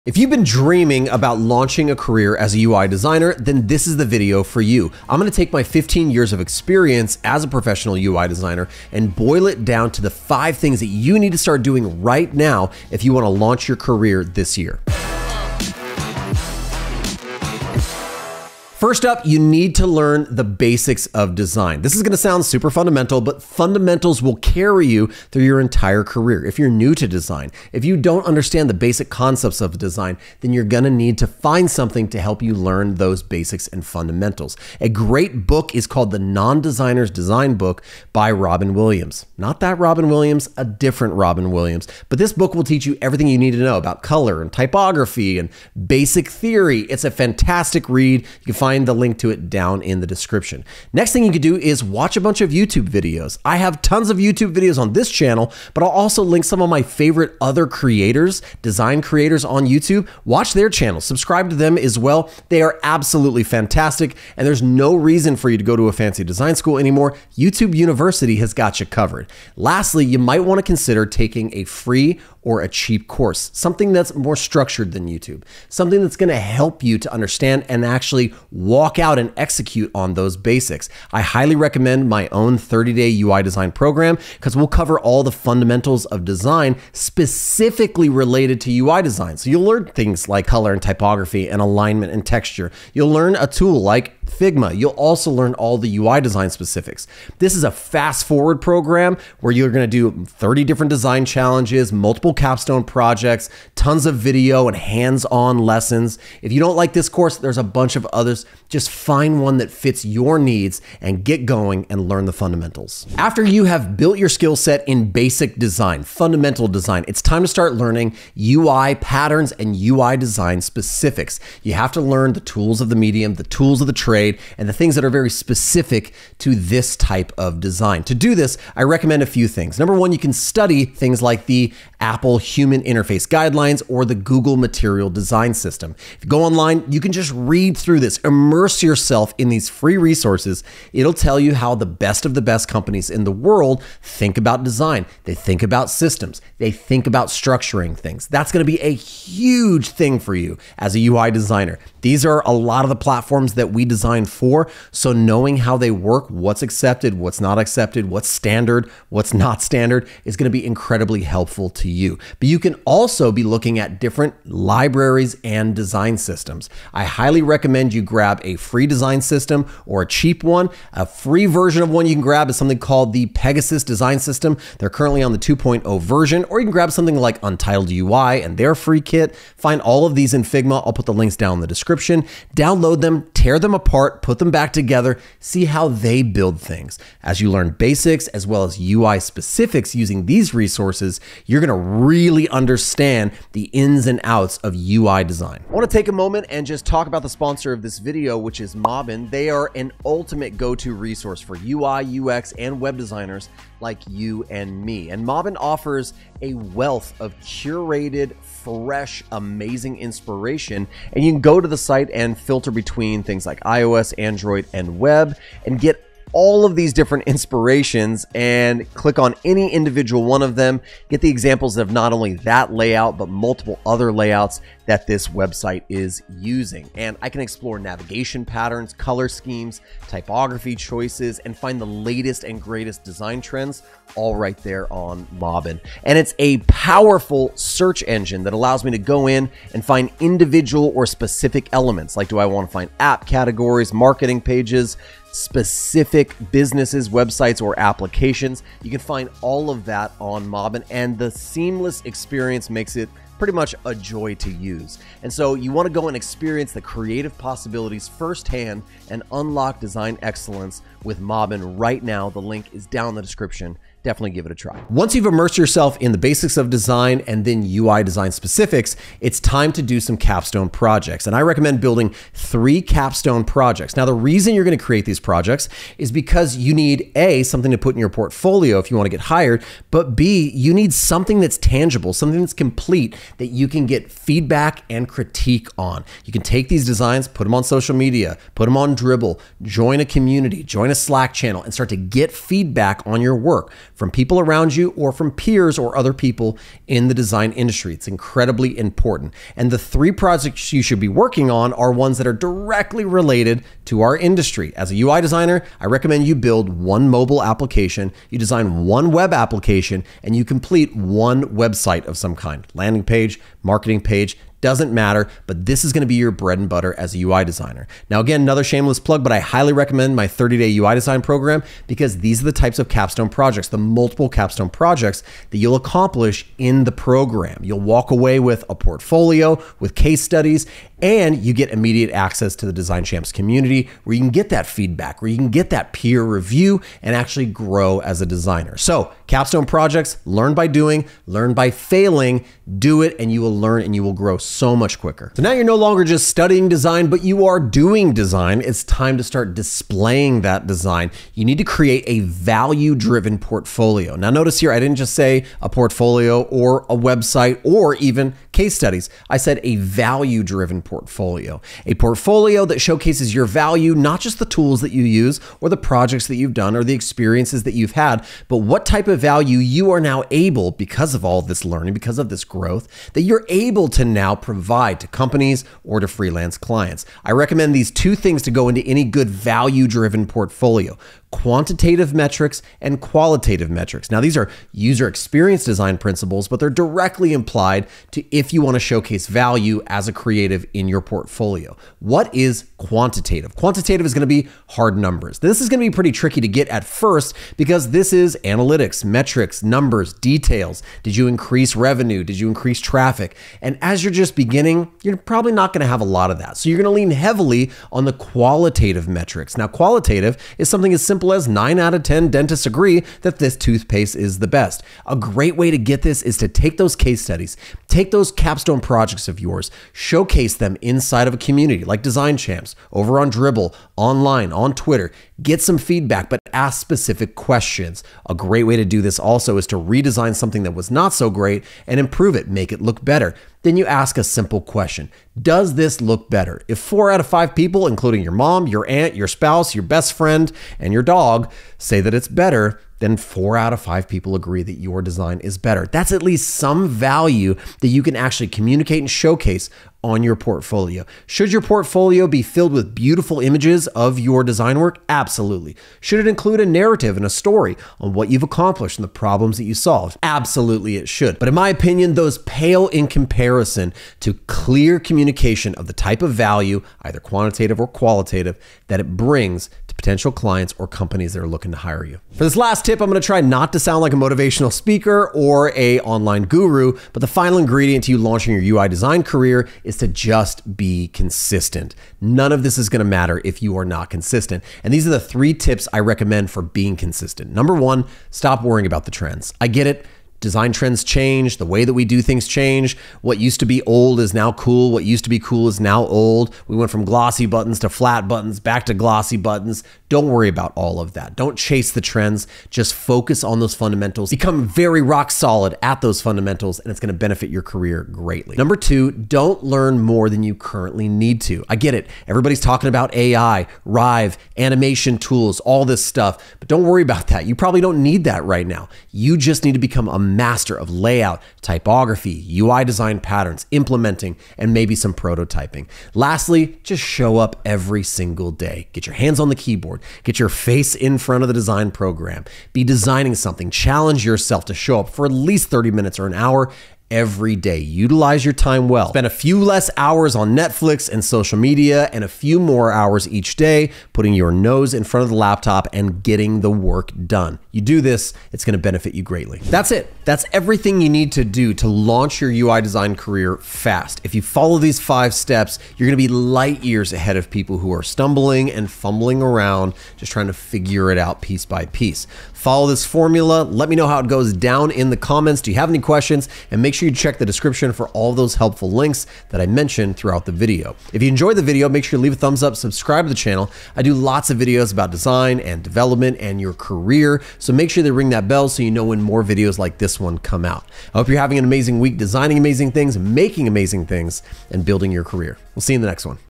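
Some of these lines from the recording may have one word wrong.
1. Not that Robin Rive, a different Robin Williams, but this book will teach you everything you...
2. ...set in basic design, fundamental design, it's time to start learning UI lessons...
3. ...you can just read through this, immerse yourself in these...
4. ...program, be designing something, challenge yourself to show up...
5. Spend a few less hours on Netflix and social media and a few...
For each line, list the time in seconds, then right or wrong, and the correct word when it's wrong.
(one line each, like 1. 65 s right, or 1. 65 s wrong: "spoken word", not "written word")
1. 39 s wrong: "Williams", not "Rive"
2. 114 s wrong: "patterns", not "lessons"
3. 136 s right
4. 531 s right
5. 539 s right.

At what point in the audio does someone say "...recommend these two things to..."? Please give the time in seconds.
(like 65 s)
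377 s.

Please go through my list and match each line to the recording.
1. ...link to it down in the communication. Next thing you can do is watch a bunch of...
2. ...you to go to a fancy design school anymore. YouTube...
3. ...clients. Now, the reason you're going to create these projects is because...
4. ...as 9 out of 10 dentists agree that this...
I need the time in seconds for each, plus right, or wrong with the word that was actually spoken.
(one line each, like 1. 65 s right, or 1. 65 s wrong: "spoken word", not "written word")
1. 48 s wrong: "description", not "communication"
2. 65 s right
3. 273 s wrong: "projects", not "clients"
4. 411 s right.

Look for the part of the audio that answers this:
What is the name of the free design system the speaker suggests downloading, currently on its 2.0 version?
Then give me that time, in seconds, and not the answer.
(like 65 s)
173 s.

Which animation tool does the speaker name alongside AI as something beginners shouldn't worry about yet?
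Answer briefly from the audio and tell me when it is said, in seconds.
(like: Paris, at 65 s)
Rive, at 513 s.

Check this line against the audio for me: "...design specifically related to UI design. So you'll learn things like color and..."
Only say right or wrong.
right.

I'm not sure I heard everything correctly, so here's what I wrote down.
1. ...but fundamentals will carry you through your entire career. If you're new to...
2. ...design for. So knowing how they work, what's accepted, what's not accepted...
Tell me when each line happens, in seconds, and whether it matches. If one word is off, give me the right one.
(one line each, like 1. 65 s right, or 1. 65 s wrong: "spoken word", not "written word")
1. 23 s right
2. 153 s right.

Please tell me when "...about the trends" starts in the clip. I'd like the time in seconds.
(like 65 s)
488 s.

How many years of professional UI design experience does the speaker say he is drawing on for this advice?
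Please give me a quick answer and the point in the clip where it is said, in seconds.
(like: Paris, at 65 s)
15, at 5 s.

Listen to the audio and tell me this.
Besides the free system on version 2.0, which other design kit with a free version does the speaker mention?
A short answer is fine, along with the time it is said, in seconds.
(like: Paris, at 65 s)
Untitled UI, at 177 s.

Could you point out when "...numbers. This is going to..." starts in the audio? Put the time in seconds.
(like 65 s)
394 s.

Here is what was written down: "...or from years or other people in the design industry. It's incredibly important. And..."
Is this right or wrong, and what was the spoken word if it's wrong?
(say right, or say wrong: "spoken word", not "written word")
wrong: "peers", not "years".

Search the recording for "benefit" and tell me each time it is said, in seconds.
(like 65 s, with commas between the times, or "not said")
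507 s, 548 s.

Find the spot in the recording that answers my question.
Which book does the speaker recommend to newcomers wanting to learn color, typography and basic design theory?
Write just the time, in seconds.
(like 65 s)
36 s.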